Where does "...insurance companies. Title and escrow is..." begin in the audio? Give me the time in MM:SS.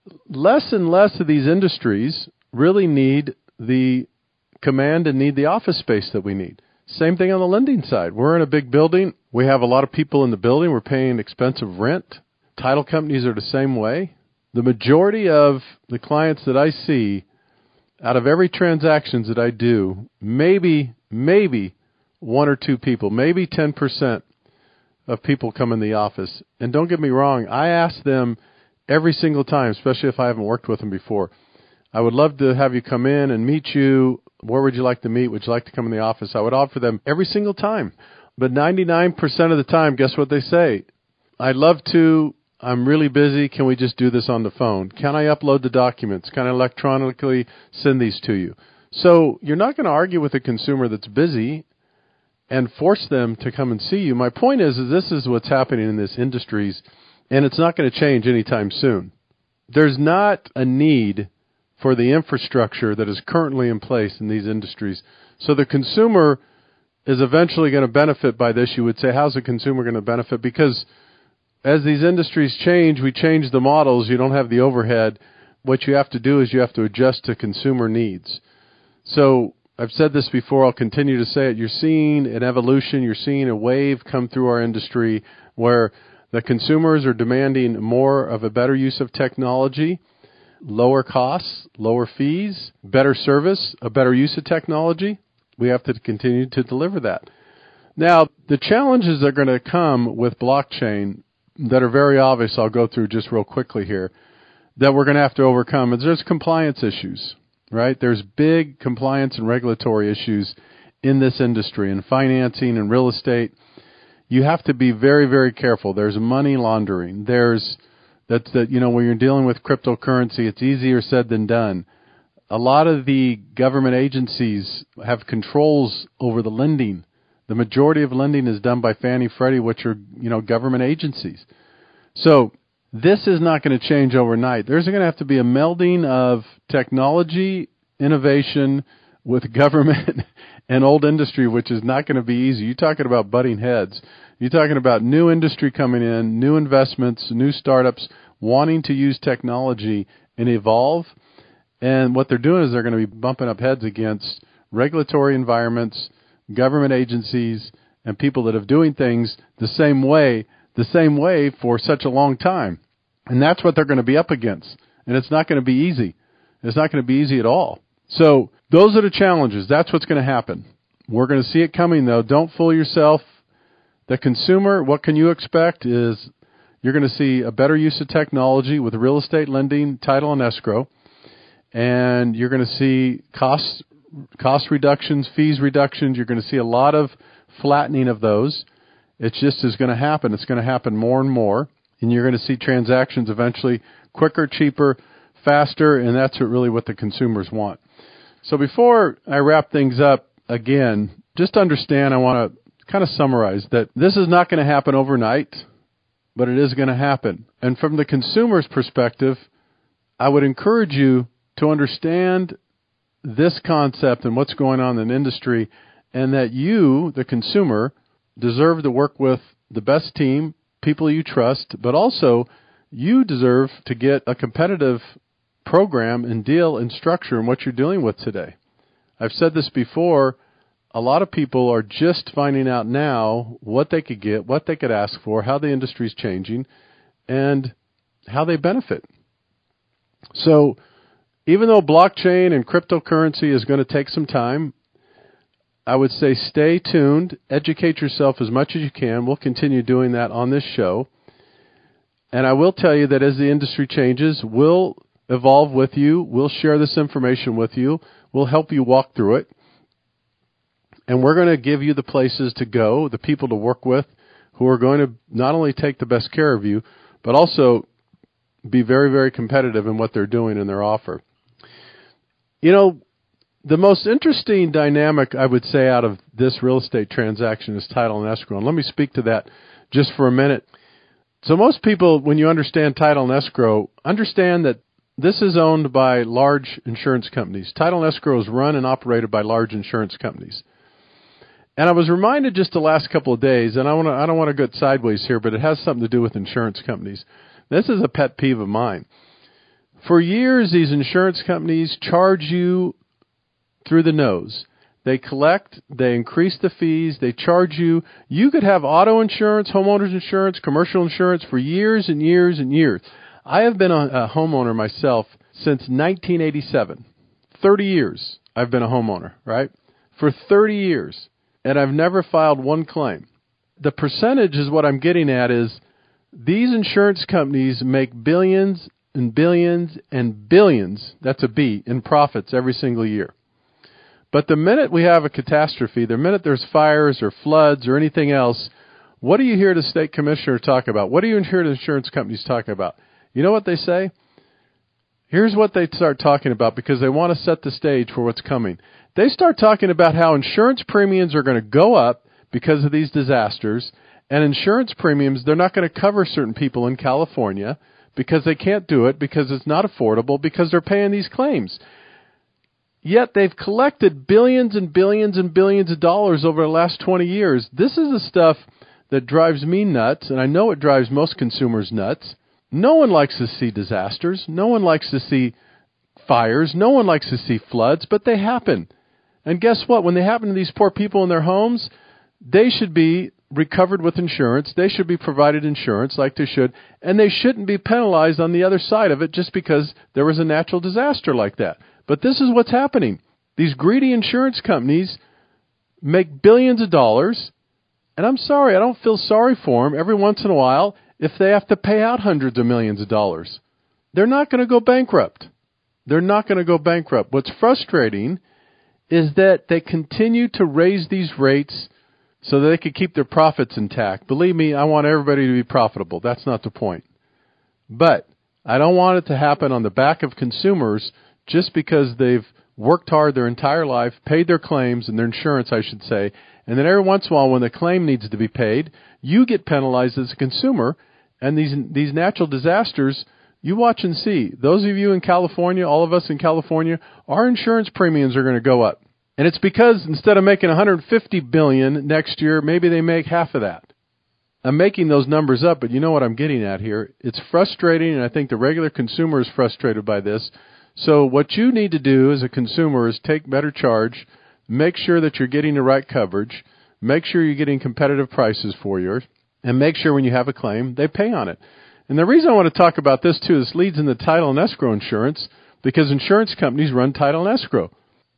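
04:46.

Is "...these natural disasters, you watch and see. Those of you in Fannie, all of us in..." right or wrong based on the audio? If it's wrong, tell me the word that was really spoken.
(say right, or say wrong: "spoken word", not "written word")
wrong: "California", not "Fannie".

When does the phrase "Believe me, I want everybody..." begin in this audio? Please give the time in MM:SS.
06:54.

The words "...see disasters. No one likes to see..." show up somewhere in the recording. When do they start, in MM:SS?
06:13.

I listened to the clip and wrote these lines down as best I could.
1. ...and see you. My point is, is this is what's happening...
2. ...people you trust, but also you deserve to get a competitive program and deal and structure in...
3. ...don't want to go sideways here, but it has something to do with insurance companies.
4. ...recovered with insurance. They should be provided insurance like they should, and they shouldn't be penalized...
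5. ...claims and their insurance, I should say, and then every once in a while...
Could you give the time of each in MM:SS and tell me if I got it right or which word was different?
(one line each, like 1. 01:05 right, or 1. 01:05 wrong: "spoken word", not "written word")
1. 00:53 right
2. 03:40 right
3. 04:54 right
4. 06:23 right
5. 07:04 right.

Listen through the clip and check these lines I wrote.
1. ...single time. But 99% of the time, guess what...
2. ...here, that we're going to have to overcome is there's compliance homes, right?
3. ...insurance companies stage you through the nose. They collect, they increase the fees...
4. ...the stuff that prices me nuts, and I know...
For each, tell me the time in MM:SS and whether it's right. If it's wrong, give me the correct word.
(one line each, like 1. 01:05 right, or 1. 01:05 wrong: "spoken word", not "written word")
1. 00:37 right
2. 01:43 wrong: "issues", not "homes"
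3. 05:00 wrong: "charge", not "stage"
4. 06:08 wrong: "drives", not "prices".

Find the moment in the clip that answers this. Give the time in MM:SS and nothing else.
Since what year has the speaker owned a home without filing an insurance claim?
05:15.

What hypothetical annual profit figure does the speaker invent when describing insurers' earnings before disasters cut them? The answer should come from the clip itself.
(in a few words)
150 billion.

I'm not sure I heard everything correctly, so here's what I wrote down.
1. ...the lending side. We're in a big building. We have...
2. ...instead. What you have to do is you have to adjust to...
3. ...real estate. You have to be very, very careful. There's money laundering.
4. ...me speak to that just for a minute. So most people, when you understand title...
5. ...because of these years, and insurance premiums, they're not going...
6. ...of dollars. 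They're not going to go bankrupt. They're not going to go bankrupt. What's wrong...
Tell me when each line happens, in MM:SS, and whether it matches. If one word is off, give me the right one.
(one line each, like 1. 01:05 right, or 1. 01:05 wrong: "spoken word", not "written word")
1. 00:07 right
2. 01:14 wrong: "overhead", not "instead"
3. 01:52 right
4. 04:38 right
5. 05:52 wrong: "disasters", not "years"
6. 06:42 wrong: "frustrating", not "wrong".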